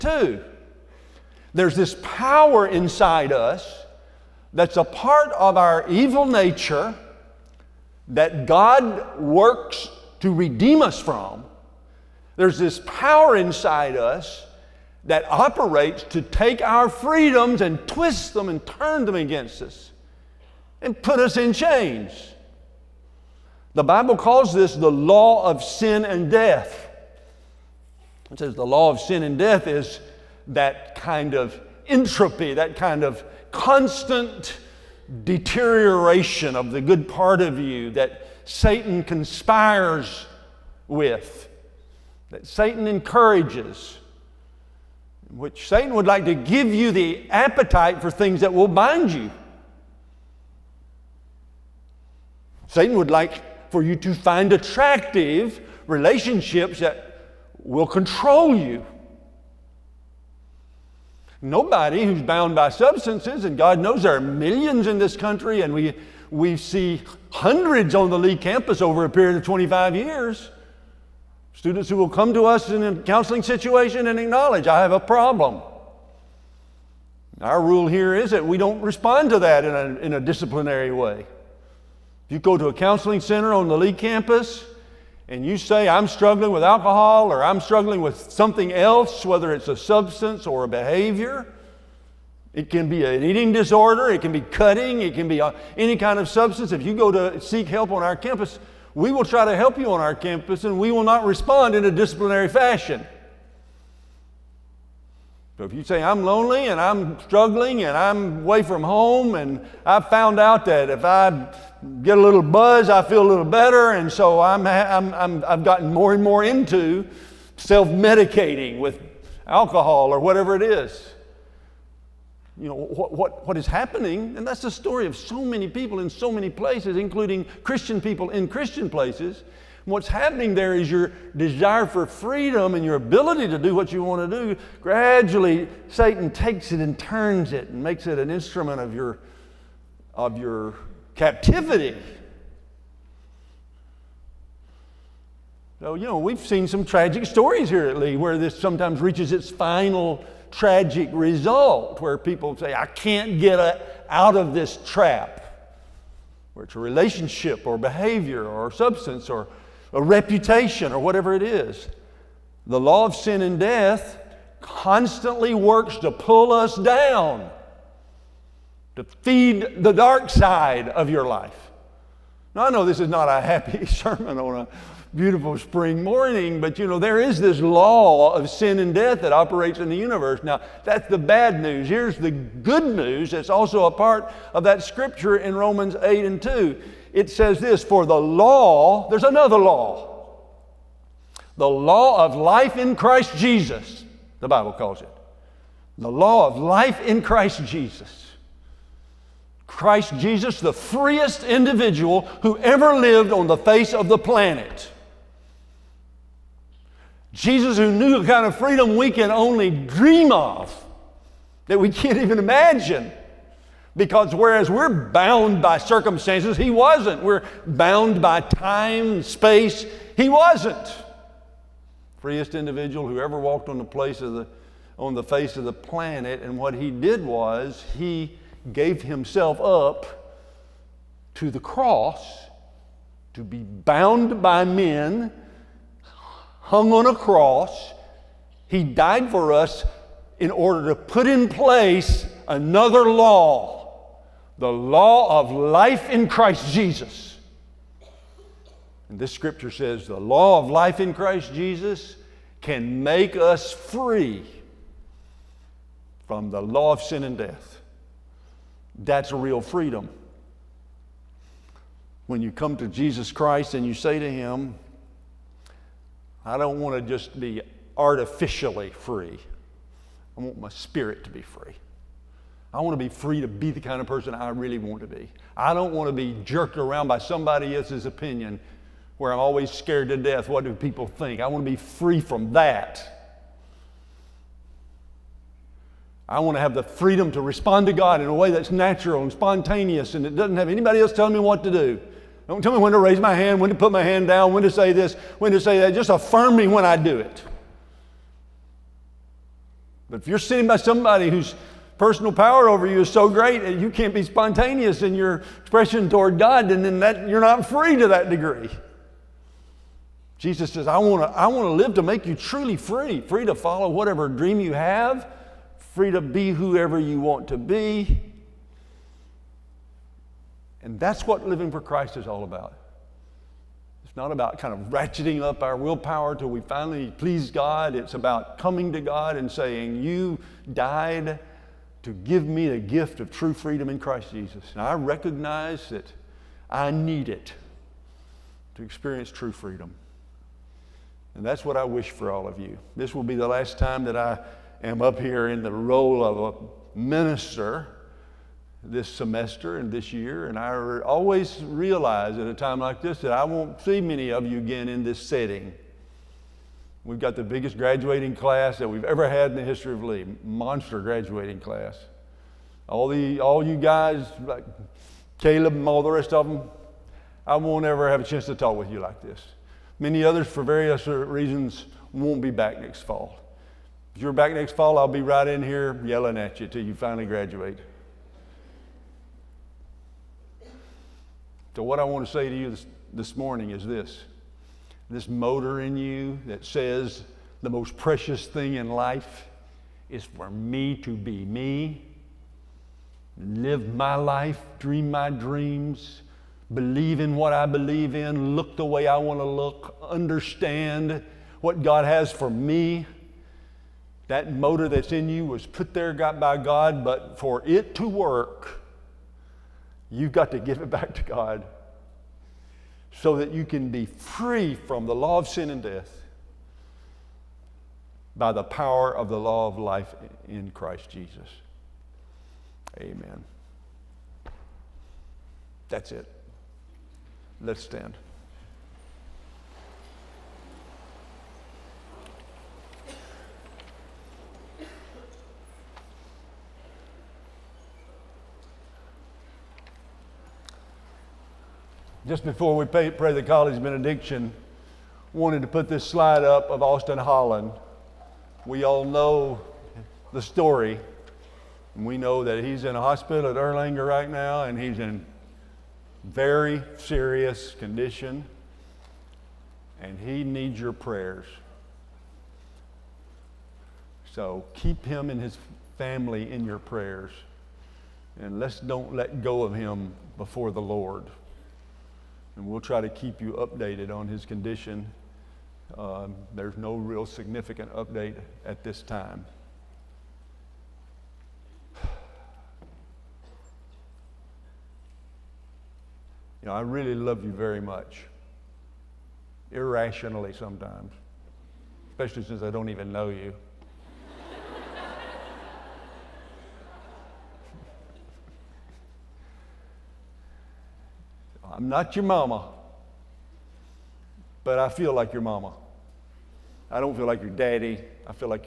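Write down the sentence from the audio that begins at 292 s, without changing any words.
Don't tell me when to raise my hand, when to put my hand down, when to say this, when to say that.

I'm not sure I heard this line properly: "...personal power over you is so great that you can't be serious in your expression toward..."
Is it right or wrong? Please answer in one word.
wrong.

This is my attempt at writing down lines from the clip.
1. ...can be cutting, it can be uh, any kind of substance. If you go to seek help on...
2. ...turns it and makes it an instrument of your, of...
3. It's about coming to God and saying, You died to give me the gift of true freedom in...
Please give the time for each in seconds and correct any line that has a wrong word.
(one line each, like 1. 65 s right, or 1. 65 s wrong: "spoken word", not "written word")
1. 94 s right
2. 136 s right
3. 327 s right.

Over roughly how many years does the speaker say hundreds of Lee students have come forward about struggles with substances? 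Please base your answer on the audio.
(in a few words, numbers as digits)
25 years.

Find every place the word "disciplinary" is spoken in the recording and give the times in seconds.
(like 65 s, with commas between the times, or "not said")
80 s, 101 s.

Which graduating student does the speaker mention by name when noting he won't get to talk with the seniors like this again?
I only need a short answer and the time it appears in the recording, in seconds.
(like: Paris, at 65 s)
Caleb, at 365 s.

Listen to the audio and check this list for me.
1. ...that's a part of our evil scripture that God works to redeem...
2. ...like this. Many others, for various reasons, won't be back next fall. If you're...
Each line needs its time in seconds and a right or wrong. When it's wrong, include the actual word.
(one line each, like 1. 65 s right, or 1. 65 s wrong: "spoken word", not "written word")
1. 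4 s wrong: "nature", not "scripture"
2. 369 s right.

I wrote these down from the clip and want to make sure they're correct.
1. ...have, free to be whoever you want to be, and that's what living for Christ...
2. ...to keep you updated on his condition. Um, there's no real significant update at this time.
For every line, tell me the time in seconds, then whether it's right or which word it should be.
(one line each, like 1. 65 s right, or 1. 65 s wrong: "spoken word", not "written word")
1. 314 s right
2. 473 s right.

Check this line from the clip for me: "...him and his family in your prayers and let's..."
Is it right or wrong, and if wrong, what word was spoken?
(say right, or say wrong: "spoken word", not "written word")
right.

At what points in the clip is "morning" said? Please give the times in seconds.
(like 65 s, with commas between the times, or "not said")
176 s, 383 s.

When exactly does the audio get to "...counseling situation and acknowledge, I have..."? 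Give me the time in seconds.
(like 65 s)
72 s.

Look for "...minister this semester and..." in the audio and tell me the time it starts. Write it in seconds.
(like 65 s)
346 s.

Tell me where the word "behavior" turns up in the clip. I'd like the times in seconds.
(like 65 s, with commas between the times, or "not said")
90 s, 157 s.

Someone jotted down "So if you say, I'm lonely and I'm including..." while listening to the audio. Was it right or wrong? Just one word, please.
wrong.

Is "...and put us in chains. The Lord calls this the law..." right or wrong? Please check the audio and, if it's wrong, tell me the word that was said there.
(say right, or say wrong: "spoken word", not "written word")
wrong: "Bible", not "Lord".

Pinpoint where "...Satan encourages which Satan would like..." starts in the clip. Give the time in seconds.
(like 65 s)
42 s.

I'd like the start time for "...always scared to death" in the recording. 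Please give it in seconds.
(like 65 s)
279 s.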